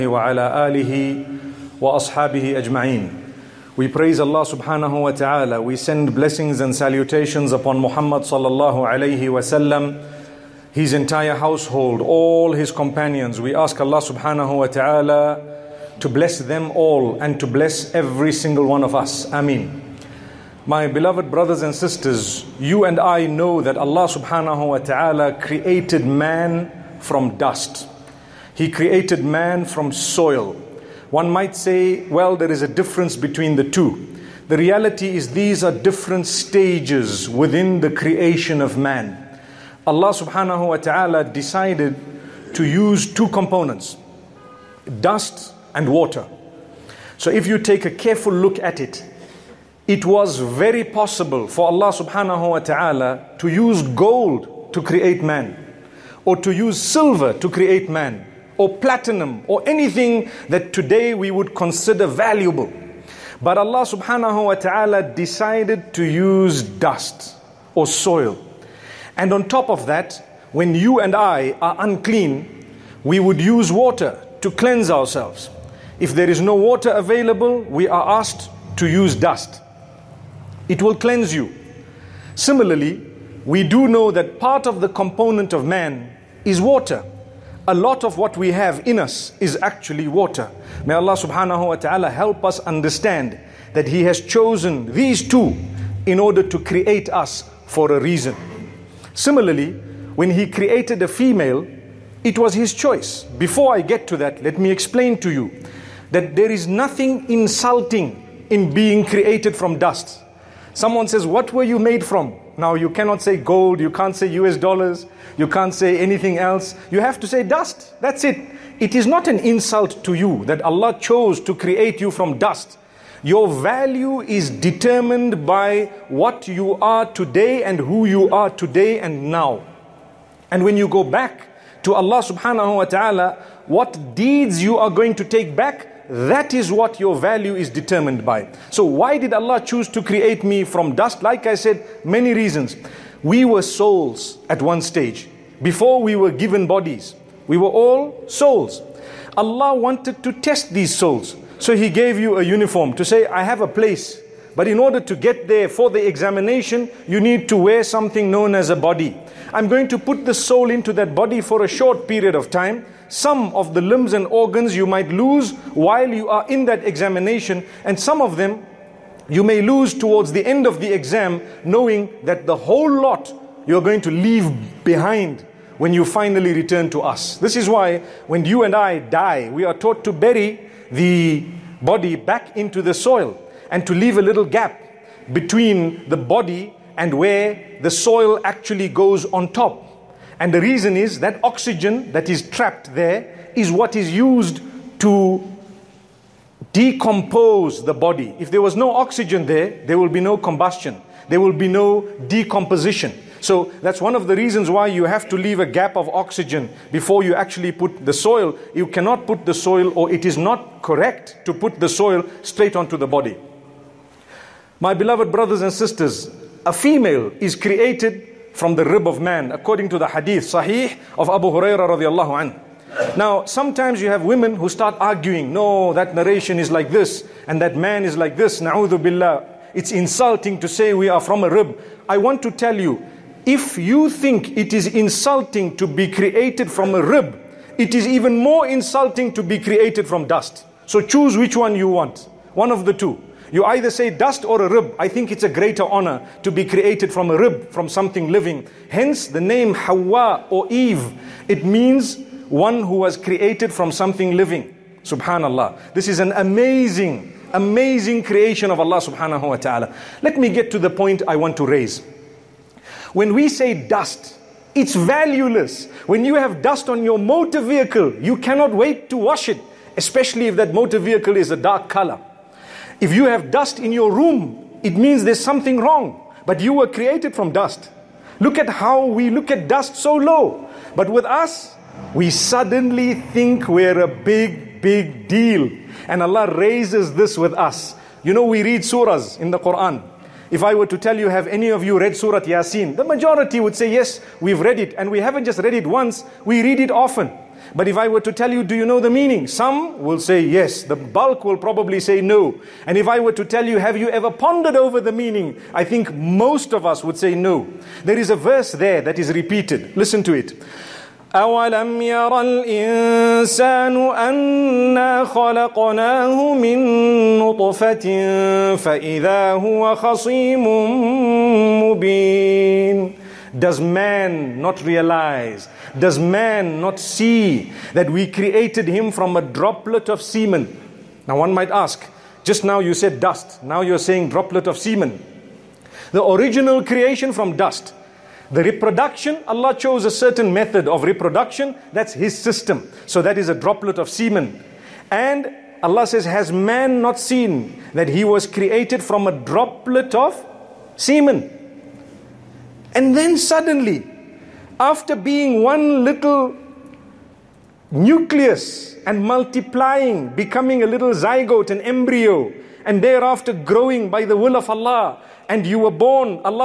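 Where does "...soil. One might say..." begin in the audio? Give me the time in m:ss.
0:29.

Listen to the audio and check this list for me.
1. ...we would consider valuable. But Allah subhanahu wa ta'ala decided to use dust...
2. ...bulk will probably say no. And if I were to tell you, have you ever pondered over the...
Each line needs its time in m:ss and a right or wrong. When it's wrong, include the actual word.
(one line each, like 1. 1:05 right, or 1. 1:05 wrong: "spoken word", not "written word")
1. 1:01 right
2. 5:00 right.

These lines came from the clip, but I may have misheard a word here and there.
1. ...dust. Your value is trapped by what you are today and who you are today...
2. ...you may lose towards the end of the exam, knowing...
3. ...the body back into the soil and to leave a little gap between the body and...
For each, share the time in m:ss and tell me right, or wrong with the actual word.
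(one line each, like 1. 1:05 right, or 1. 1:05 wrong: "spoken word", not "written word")
1. 2:02 wrong: "determined", not "trapped"
2. 2:49 right
3. 3:00 right.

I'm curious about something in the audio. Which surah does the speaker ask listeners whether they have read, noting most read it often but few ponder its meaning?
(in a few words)
Surah Yasin.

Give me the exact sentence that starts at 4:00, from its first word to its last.
So choose which one you want, one of the two.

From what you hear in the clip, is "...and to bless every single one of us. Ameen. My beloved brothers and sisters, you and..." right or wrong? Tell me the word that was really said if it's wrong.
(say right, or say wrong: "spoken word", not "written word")
right.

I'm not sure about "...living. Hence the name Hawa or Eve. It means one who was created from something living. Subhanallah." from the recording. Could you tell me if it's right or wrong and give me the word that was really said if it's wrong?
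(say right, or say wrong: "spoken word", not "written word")
right.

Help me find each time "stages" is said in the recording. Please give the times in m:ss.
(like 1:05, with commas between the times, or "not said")
0:36, 2:24.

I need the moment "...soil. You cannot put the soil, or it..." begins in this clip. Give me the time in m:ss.
3:28.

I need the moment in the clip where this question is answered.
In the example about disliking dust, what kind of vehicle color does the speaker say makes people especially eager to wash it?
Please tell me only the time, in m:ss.
4:31.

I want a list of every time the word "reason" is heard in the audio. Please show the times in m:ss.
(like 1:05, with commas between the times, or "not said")
1:38, 2:22, 3:10, 3:24.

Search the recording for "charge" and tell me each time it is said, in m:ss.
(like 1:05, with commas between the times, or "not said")
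not said.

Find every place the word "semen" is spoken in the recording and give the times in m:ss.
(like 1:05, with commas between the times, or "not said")
5:30, 5:34, 5:44, 5:50.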